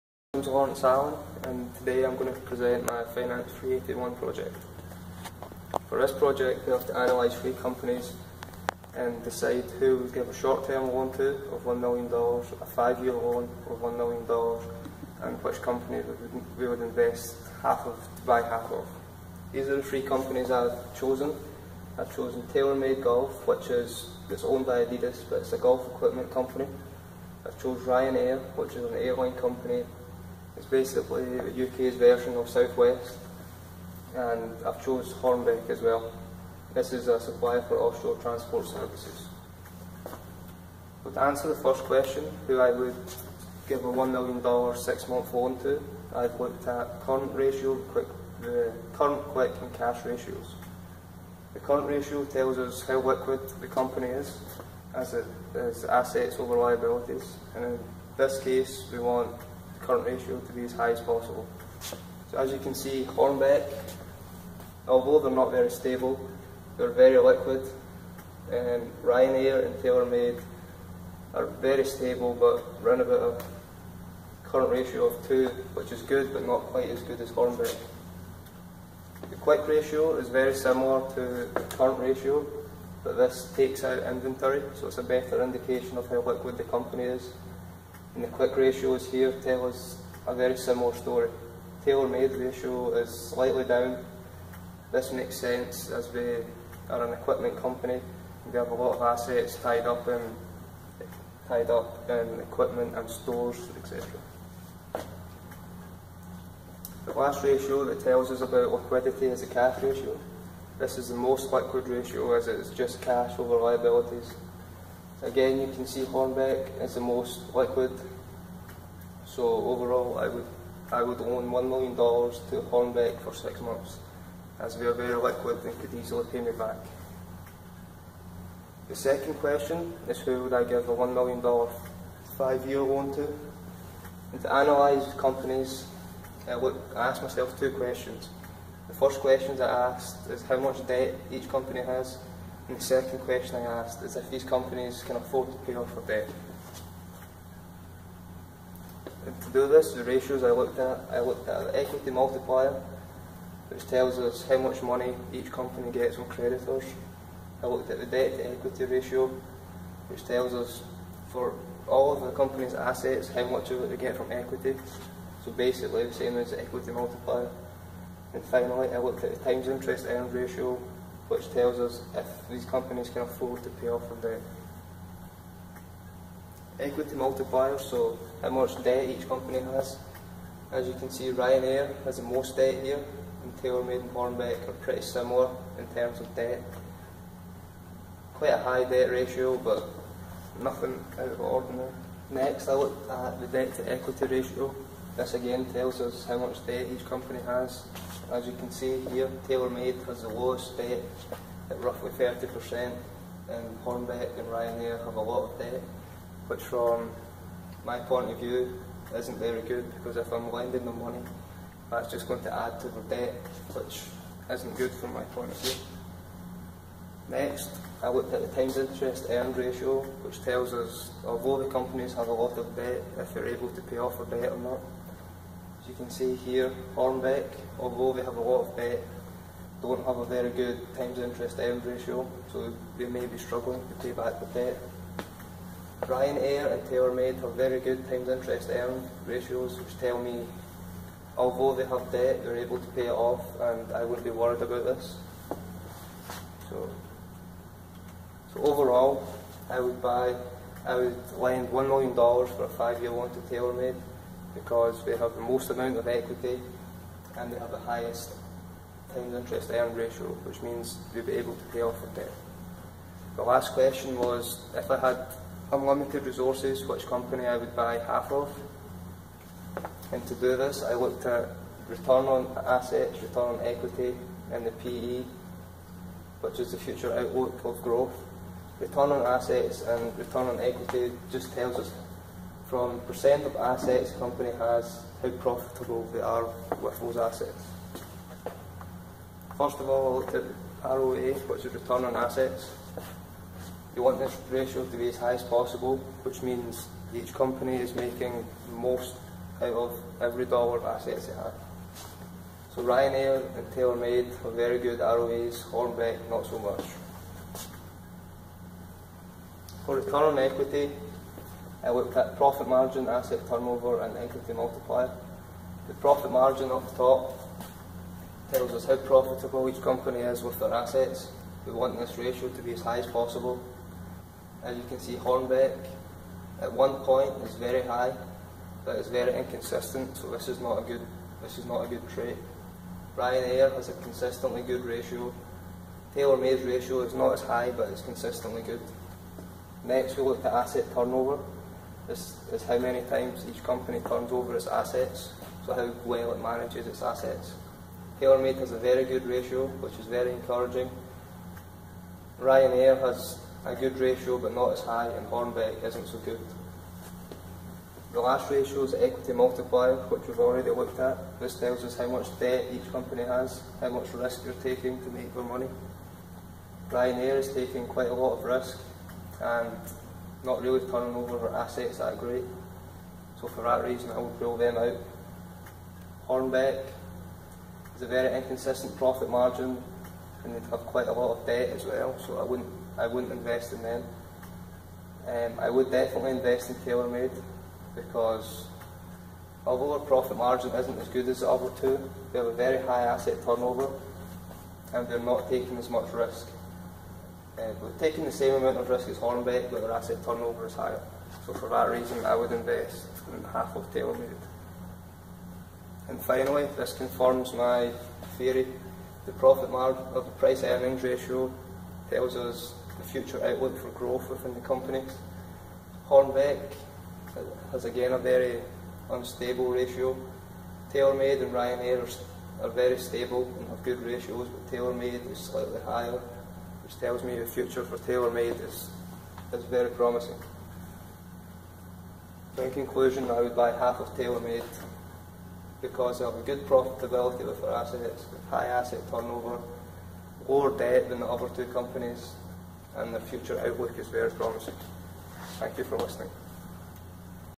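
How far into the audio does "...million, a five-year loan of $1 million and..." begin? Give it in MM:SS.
00:11.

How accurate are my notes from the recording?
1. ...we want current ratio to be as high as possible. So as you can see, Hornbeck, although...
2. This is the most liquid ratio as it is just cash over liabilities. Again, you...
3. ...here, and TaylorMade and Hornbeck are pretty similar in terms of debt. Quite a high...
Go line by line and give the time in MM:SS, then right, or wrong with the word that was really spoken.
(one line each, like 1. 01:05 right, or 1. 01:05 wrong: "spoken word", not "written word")
1. 00:58 right
2. 01:50 right
3. 03:02 right.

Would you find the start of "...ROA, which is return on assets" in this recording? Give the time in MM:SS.
04:50.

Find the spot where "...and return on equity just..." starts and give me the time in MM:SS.
04:39.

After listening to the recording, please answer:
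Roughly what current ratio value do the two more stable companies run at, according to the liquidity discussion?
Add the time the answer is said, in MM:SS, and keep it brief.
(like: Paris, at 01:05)
2, at 01:14.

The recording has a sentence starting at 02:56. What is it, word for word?
Equity multiplier, so how much debt each company has.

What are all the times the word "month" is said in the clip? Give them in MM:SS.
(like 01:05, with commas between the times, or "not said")
00:44, 02:03.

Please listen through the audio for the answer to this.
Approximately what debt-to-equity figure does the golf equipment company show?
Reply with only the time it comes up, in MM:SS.
03:21.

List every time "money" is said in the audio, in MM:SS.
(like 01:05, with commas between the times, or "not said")
02:34, 03:31, 06:05.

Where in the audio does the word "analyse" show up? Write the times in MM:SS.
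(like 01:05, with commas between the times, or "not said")
00:06, 02:14.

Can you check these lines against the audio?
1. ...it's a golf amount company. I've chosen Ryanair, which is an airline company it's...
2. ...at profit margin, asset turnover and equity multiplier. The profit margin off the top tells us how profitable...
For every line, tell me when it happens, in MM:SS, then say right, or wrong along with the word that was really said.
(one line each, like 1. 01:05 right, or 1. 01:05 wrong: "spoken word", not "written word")
1. 00:25 wrong: "equipment", not "amount"
2. 05:12 right.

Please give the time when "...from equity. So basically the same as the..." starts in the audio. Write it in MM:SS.
02:44.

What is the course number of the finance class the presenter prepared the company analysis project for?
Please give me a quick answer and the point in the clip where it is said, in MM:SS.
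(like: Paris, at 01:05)
381, at 00:03.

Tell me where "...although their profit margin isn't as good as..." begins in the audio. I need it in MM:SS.
06:29.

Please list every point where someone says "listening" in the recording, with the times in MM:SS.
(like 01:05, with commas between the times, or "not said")
07:25.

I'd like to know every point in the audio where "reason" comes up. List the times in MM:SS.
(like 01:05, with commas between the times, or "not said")
06:13, 06:41.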